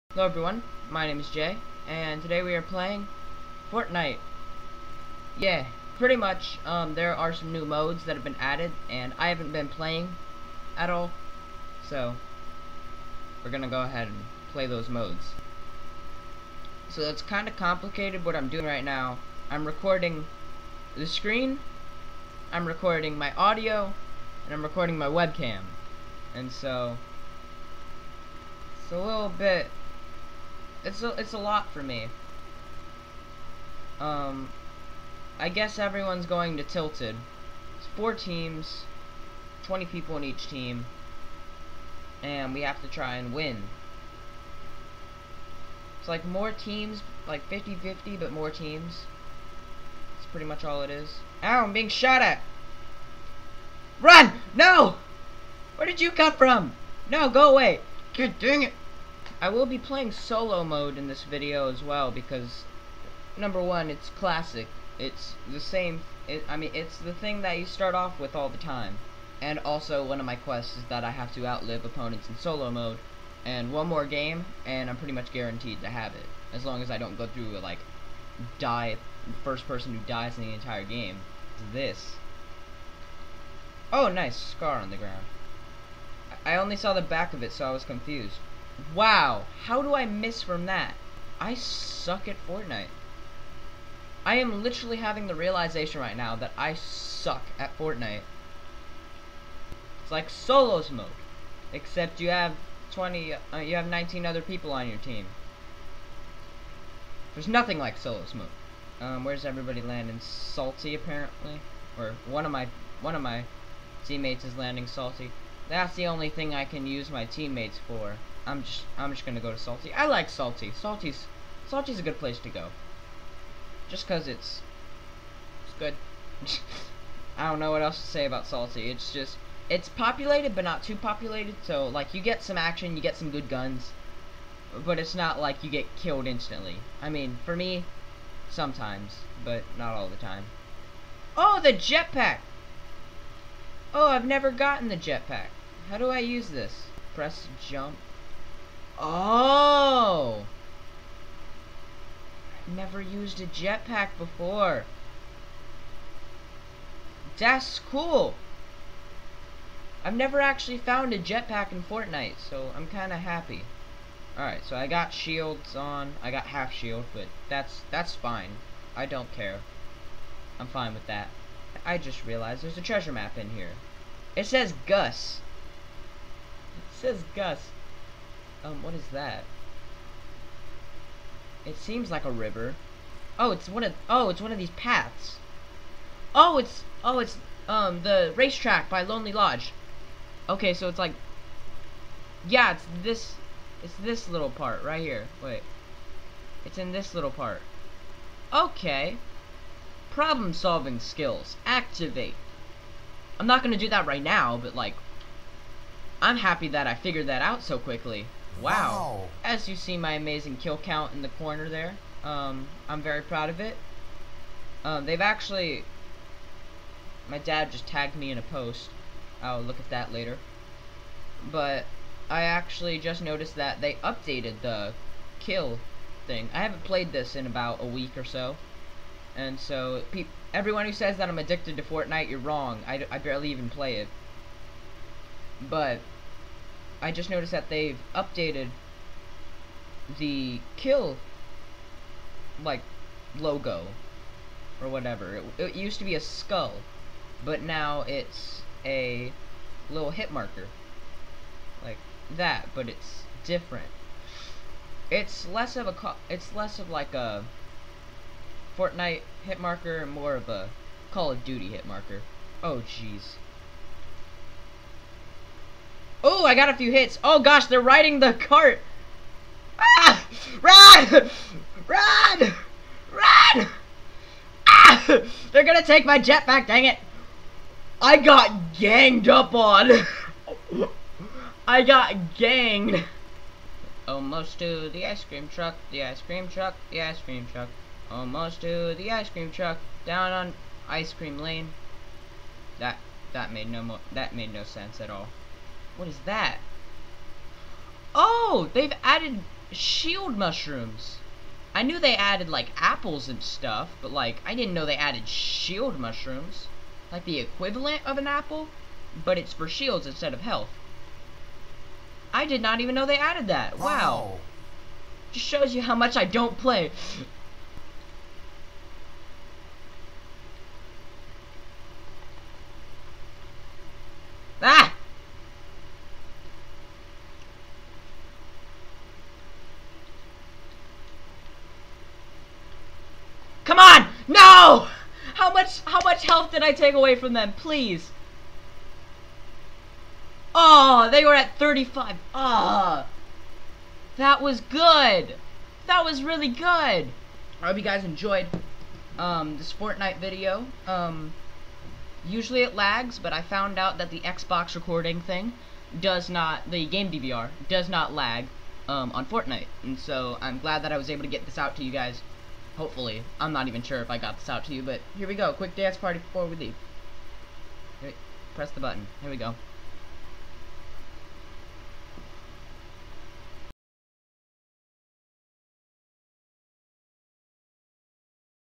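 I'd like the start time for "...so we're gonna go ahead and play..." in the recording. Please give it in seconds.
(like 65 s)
11 s.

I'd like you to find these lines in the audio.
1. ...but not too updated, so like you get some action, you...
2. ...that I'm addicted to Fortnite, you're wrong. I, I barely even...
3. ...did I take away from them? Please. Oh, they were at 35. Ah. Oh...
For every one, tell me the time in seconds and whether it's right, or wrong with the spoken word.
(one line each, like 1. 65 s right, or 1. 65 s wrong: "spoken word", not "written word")
1. 130 s wrong: "populated", not "updated"
2. 231 s right
3. 336 s right.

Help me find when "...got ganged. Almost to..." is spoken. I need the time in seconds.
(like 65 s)
281 s.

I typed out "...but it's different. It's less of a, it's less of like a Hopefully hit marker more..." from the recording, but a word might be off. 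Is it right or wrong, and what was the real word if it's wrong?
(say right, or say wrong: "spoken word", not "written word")
wrong: "Fortnite", not "Hopefully".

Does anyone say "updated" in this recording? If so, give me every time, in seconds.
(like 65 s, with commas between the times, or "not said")
224 s, 238 s.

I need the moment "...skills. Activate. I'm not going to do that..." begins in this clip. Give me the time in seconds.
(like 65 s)
200 s.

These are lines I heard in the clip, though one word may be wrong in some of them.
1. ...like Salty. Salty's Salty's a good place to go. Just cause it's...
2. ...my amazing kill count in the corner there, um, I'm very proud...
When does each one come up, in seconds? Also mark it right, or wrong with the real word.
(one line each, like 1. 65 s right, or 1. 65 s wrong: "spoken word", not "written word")
1. 120 s right
2. 209 s right.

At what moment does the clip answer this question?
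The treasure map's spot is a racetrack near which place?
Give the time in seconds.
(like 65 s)
188 s.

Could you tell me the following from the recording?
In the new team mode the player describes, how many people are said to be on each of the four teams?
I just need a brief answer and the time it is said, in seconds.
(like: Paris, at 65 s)
20, at 39 s.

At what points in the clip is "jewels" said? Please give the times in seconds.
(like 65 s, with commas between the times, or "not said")
not said.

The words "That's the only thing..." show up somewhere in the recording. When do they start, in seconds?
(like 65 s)
115 s.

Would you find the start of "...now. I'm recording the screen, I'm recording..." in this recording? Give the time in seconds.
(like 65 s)
18 s.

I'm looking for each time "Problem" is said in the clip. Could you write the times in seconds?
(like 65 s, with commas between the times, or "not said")
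200 s.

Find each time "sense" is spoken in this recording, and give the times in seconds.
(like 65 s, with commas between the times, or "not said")
294 s.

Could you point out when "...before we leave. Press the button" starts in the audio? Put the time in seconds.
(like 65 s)
366 s.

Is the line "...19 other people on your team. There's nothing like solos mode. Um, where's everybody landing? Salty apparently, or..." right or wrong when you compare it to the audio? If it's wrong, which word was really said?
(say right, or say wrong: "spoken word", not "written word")
right.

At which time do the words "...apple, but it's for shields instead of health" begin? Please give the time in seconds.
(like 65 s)
308 s.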